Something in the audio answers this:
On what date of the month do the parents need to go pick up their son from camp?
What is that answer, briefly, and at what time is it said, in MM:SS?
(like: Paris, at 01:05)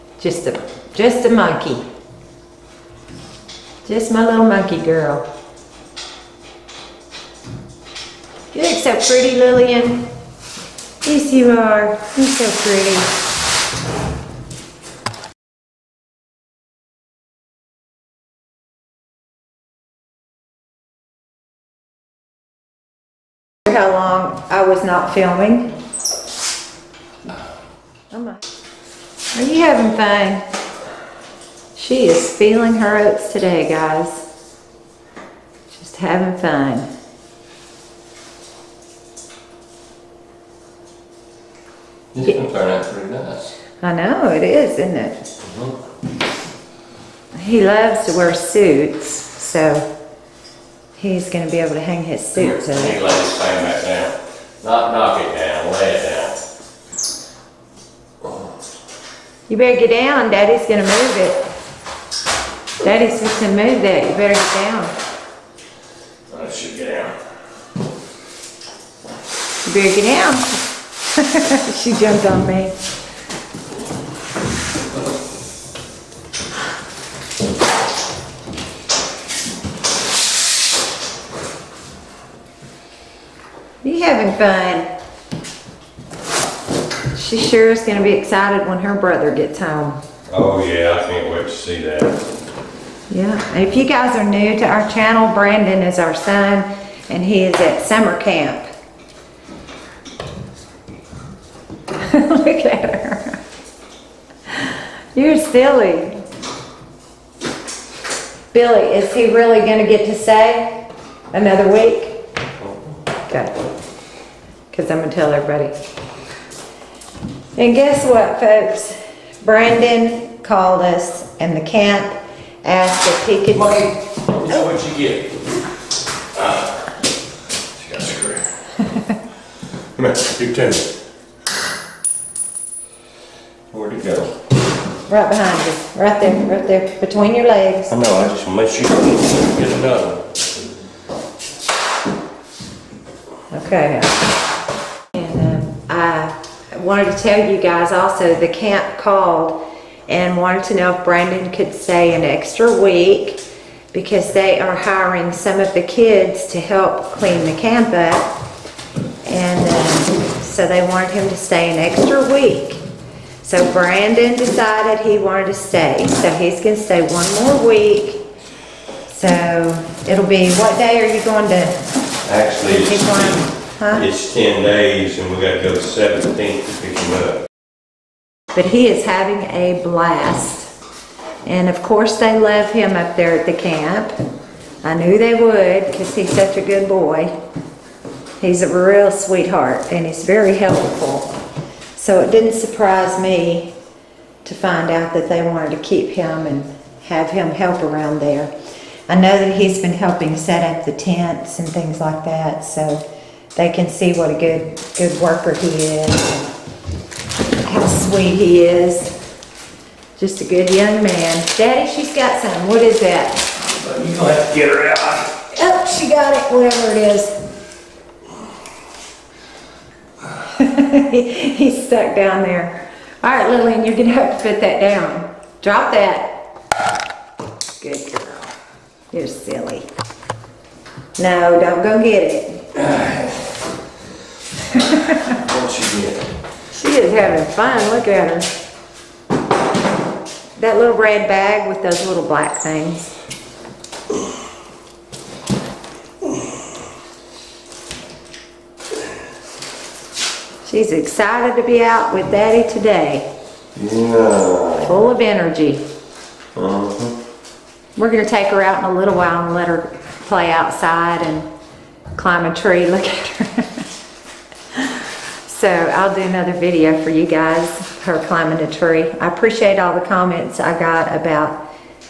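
17th, at 02:55.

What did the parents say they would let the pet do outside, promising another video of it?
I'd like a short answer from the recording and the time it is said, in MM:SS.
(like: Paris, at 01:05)
climb a tree, at 04:22.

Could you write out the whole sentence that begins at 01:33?
Yeah, if you guys are new to our channel, Brandon is our son and he is at summer camp.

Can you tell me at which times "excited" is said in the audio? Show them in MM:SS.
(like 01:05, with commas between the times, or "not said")
01:28, 04:10.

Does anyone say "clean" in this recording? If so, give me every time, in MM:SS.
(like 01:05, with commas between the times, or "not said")
02:37.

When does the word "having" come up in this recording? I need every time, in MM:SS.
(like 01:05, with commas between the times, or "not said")
00:29, 00:35, 01:24, 02:59, 03:57.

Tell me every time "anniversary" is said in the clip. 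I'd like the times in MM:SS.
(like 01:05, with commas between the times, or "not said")
not said.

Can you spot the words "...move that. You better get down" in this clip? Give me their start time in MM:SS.
01:03.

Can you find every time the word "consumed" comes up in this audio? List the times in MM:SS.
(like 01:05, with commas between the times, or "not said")
not said.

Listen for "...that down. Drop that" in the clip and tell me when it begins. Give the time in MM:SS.
03:44.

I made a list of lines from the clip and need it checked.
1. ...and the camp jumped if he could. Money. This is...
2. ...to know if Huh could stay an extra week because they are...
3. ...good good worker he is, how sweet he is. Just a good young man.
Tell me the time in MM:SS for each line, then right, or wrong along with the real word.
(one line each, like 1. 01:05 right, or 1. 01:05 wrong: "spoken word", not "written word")
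1. 02:01 wrong: "asked", not "jumped"
2. 02:30 wrong: "Brandon", not "Huh"
3. 03:24 right.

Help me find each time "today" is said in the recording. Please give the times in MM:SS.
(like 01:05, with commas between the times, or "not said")
00:33, 04:12.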